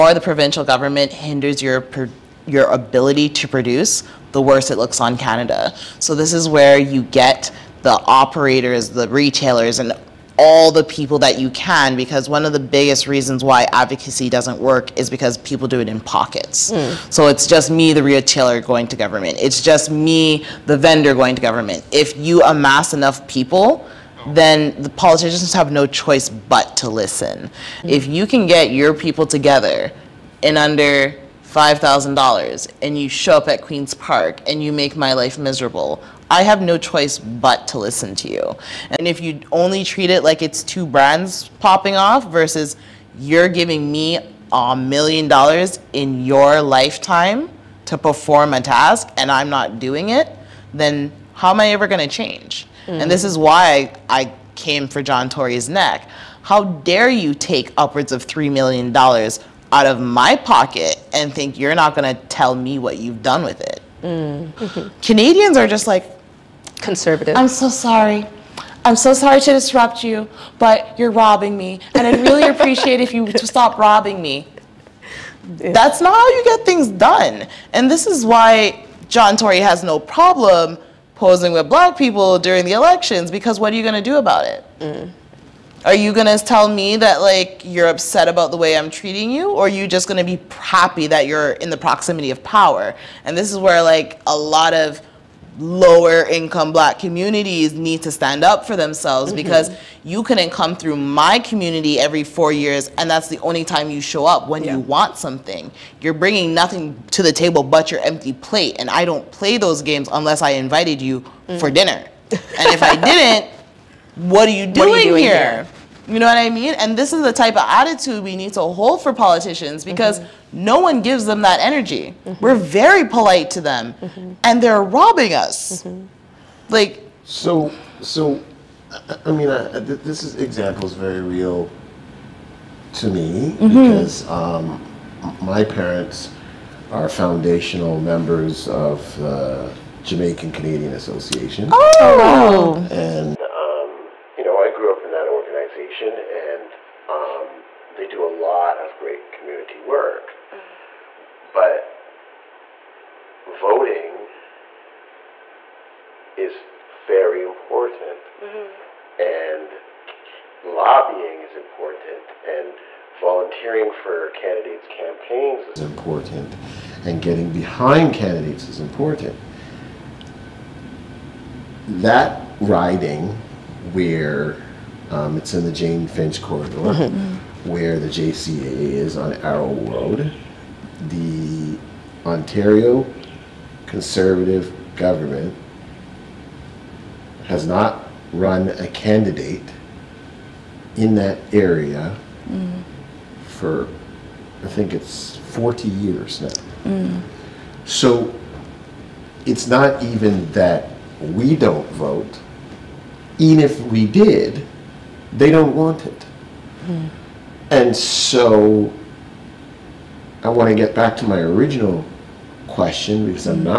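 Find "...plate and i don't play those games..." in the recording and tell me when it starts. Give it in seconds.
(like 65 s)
108 s.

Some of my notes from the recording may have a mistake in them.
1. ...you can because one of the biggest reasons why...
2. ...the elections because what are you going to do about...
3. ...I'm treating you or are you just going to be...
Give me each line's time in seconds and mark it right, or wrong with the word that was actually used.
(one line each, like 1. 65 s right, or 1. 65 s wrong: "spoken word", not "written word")
1. 11 s right
2. 82 s right
3. 88 s right.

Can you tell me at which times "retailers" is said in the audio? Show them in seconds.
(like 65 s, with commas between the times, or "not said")
9 s, 18 s.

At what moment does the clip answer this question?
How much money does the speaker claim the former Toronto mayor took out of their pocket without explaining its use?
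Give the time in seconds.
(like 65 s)
58 s.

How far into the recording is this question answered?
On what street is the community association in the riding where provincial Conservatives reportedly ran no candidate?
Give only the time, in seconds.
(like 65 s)
179 s.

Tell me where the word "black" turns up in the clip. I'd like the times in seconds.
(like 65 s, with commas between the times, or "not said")
81 s, 96 s.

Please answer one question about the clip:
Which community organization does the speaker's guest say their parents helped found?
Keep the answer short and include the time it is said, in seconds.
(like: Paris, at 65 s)
Jamaican Canadian Association, at 140 s.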